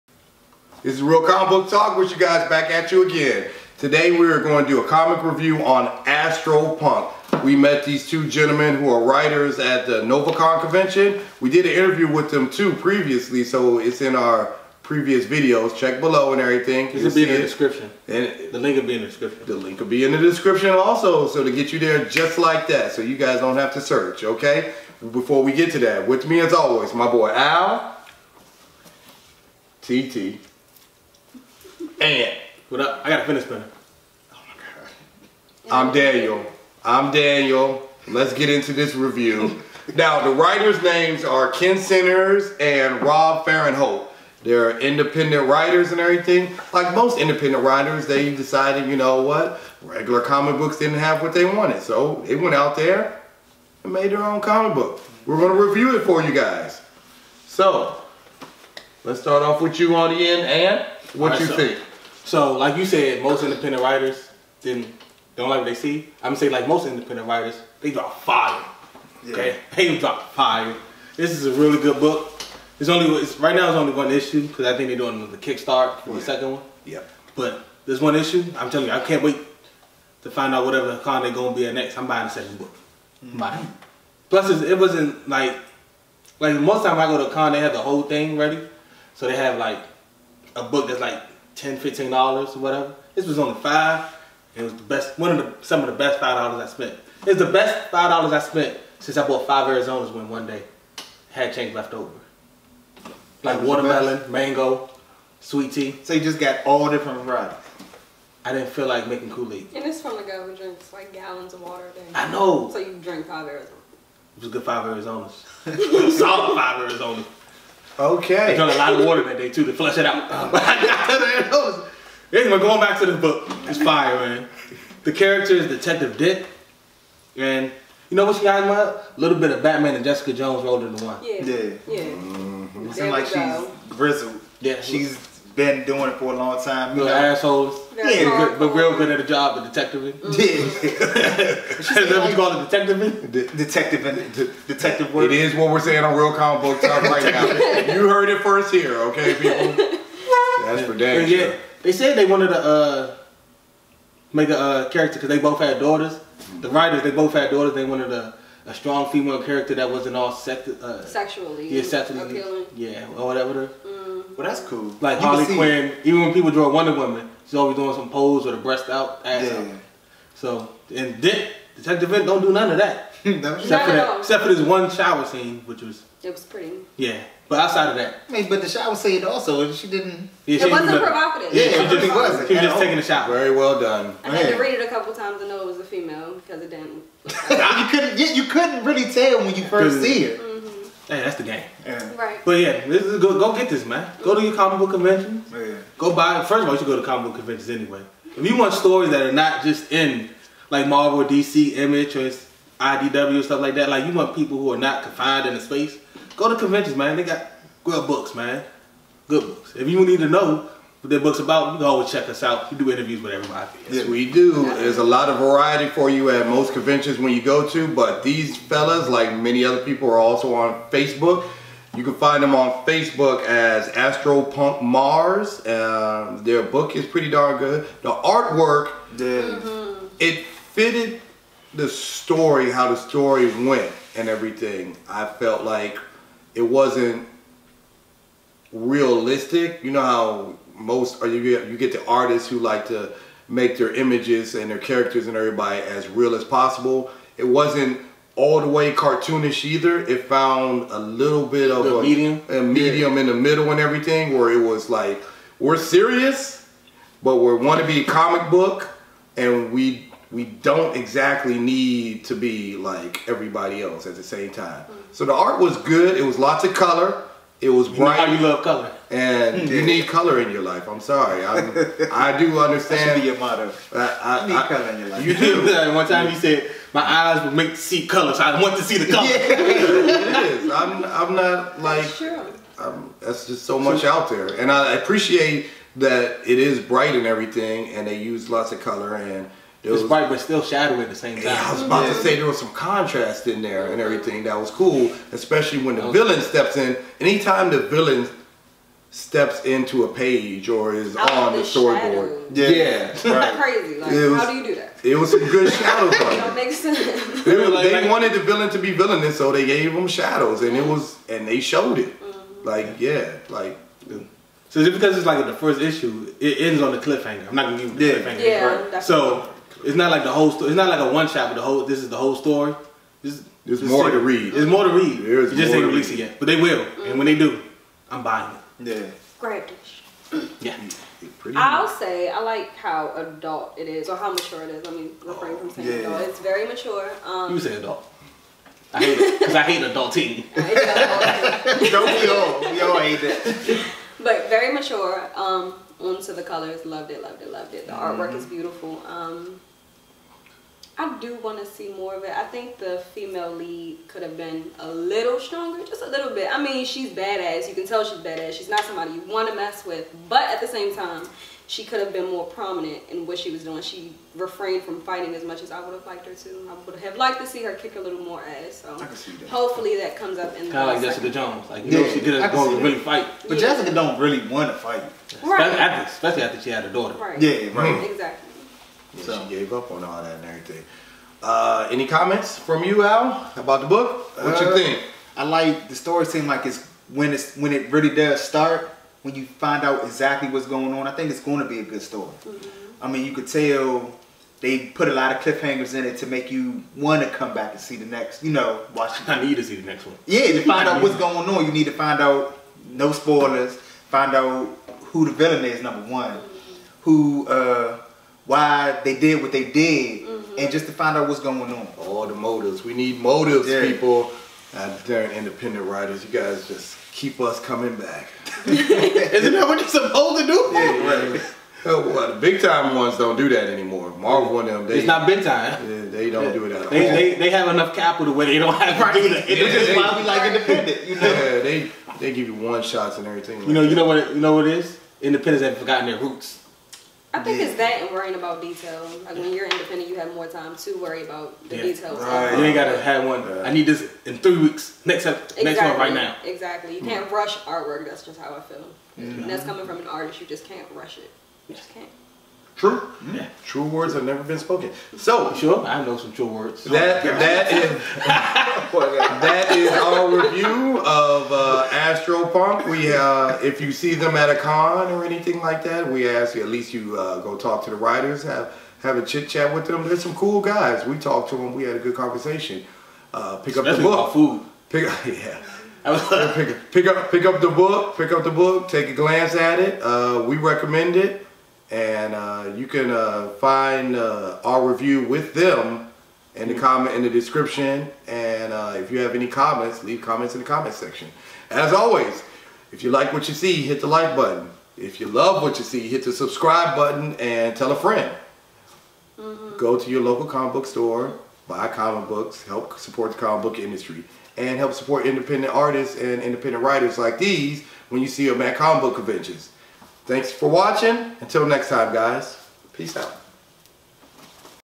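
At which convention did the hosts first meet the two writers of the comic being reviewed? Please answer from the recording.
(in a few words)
NovaCon.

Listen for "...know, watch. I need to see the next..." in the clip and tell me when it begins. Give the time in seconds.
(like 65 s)
398 s.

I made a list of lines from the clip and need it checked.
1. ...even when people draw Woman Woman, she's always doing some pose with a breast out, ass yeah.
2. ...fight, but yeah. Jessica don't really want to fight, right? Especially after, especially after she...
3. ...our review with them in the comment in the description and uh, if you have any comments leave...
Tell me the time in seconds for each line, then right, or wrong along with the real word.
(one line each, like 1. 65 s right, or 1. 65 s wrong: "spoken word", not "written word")
1. 166 s wrong: "Wonder", not "Woman"
2. 372 s right
3. 484 s right.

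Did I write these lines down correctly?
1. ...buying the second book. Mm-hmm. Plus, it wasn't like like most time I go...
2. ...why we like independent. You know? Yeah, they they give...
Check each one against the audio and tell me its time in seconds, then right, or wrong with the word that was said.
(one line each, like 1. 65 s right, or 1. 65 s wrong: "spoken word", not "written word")
1. 82 s right
2. 429 s right.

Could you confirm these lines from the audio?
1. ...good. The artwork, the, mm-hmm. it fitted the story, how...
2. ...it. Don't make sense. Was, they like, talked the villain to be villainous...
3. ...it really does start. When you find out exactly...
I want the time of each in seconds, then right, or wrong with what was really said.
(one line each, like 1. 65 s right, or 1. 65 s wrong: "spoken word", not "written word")
1. 227 s right
2. 306 s wrong: "wanted", not "talked"
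3. 387 s right.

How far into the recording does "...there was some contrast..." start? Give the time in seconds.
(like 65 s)
292 s.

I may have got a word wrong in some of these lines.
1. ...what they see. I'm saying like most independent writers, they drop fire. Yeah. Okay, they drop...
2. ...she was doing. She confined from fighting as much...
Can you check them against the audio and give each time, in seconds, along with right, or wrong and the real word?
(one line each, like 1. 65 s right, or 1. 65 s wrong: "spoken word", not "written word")
1. 65 s right
2. 363 s wrong: "refrained", not "confined".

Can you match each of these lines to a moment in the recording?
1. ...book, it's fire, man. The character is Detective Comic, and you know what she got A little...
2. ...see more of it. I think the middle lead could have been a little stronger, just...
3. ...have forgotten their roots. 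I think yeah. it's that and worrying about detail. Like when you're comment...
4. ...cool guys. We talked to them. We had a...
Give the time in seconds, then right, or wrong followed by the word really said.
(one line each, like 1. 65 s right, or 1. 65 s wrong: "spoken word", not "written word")
1. 123 s wrong: "Dick", not "Comic"
2. 351 s wrong: "female", not "middle"
3. 435 s wrong: "independent", not "comment"
4. 470 s right.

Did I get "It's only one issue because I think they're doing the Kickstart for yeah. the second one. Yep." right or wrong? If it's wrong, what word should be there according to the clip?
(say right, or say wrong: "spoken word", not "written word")
right.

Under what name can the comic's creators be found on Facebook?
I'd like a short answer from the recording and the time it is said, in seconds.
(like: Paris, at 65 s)
Astro Punk Mars, at 223 s.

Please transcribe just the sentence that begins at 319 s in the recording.
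So it's not like the whole story.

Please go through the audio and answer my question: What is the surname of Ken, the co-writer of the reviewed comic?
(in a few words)
Sinners.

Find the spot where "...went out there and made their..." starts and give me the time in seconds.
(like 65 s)
52 s.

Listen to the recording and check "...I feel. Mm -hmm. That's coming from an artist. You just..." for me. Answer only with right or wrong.
right.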